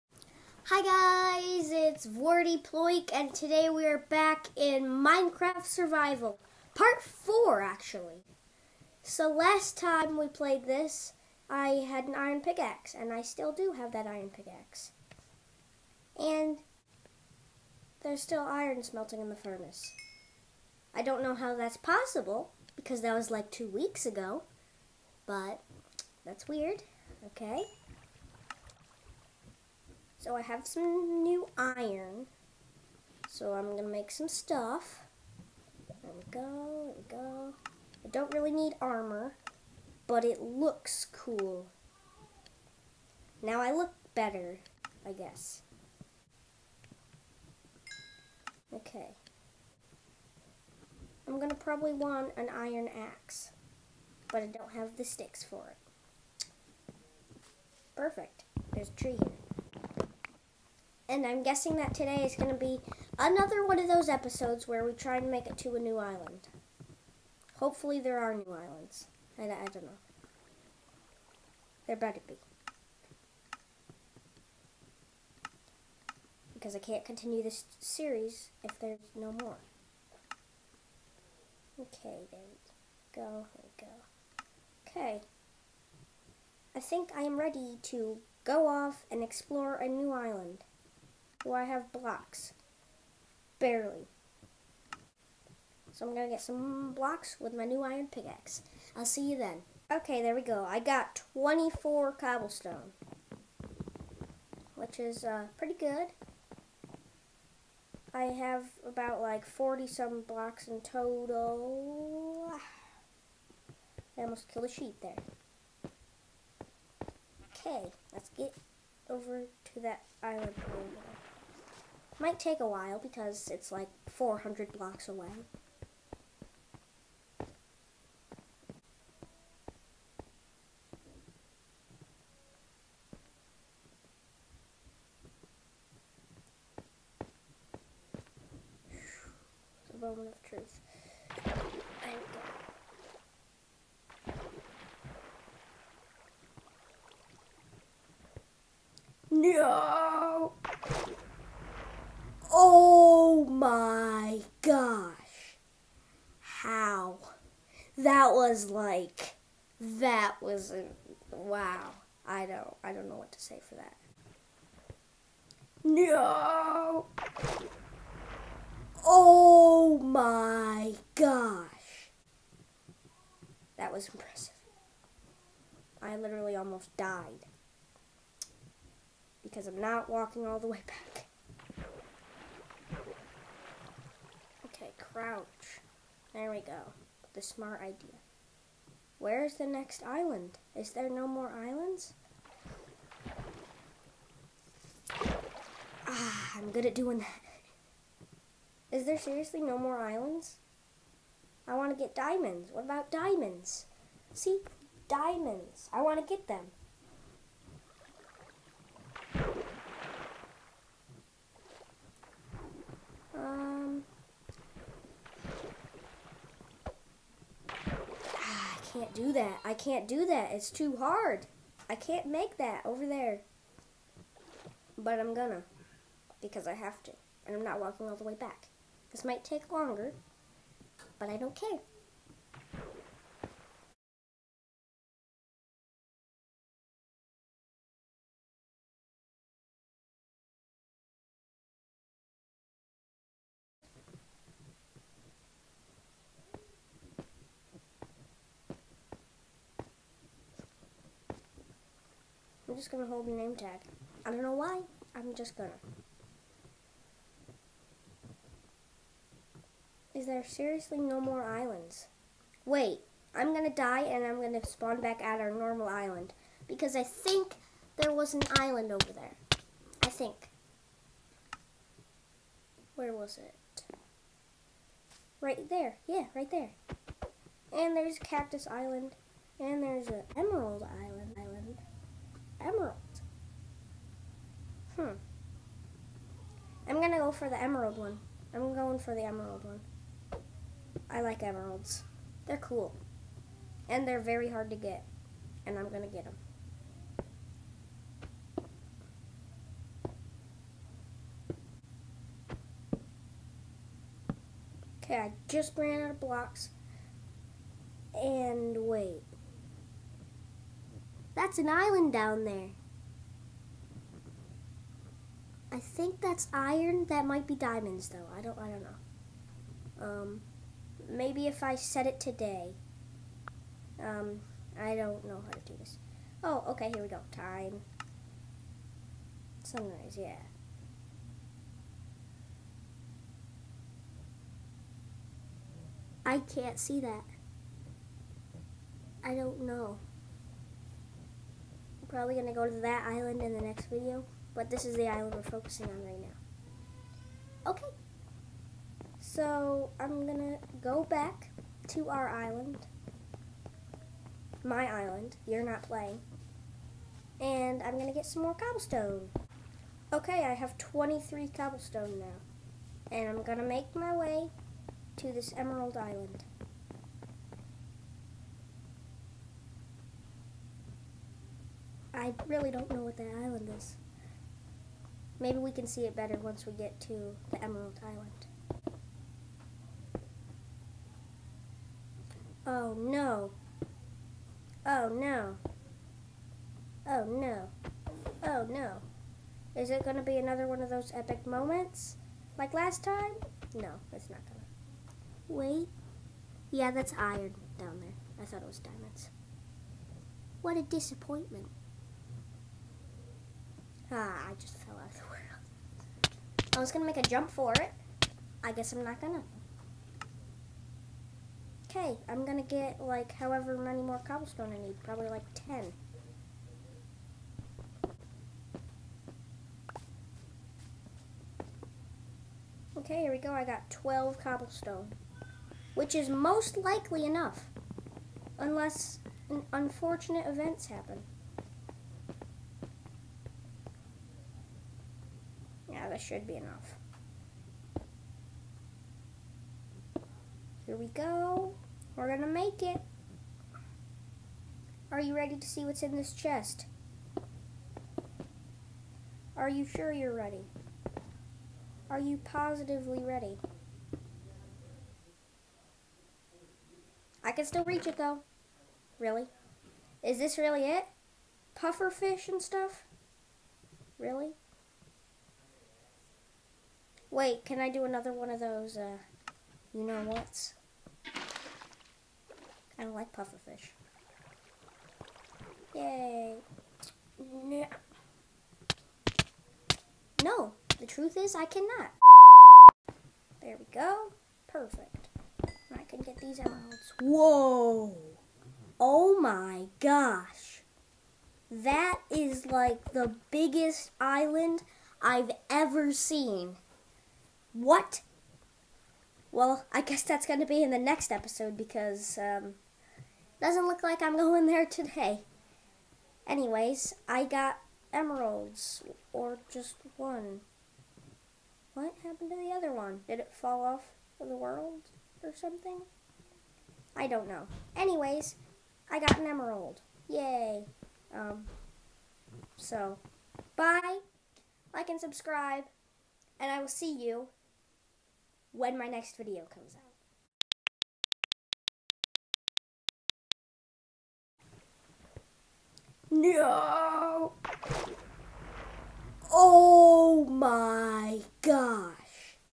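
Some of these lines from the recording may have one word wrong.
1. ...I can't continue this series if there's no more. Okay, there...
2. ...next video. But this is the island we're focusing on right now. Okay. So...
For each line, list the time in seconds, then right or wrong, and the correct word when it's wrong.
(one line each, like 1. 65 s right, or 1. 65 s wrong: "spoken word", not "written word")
1. 76 s right
2. 343 s right.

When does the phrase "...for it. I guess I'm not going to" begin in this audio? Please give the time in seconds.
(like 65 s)
407 s.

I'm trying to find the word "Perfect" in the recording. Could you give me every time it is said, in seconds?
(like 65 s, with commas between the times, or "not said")
57 s, 484 s.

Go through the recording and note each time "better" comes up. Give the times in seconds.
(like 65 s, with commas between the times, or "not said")
44 s, 71 s, 376 s.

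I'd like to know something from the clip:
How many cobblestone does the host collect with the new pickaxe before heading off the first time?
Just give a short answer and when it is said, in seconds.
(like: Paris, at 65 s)
24, at 101 s.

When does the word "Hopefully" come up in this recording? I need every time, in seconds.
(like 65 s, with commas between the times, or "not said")
67 s.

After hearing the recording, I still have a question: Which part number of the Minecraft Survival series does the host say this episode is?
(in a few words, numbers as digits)
4.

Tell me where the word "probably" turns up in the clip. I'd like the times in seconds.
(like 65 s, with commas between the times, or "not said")
51 s, 342 s, 415 s.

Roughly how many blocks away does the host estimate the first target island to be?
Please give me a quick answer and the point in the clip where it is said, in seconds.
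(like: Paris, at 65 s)
400, at 124 s.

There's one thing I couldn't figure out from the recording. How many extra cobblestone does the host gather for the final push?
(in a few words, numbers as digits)
12.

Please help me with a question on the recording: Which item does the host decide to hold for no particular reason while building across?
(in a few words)
name tag.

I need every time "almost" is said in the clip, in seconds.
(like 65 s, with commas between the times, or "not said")
114 s, 176 s.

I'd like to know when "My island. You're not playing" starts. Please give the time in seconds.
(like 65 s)
354 s.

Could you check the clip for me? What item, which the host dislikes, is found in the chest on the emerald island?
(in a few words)
Puffer fish.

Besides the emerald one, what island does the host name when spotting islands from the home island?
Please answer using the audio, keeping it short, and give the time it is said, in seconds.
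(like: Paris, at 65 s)
Cactus Island, at 278 s.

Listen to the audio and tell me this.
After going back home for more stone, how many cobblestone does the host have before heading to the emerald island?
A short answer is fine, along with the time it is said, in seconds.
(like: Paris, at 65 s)
23, at 360 s.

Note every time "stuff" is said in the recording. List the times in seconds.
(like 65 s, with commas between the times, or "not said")
34 s, 462 s.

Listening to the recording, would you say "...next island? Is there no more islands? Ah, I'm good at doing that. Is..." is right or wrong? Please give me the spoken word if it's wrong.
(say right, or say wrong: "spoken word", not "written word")
right.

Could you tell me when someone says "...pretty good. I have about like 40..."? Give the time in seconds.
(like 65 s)
105 s.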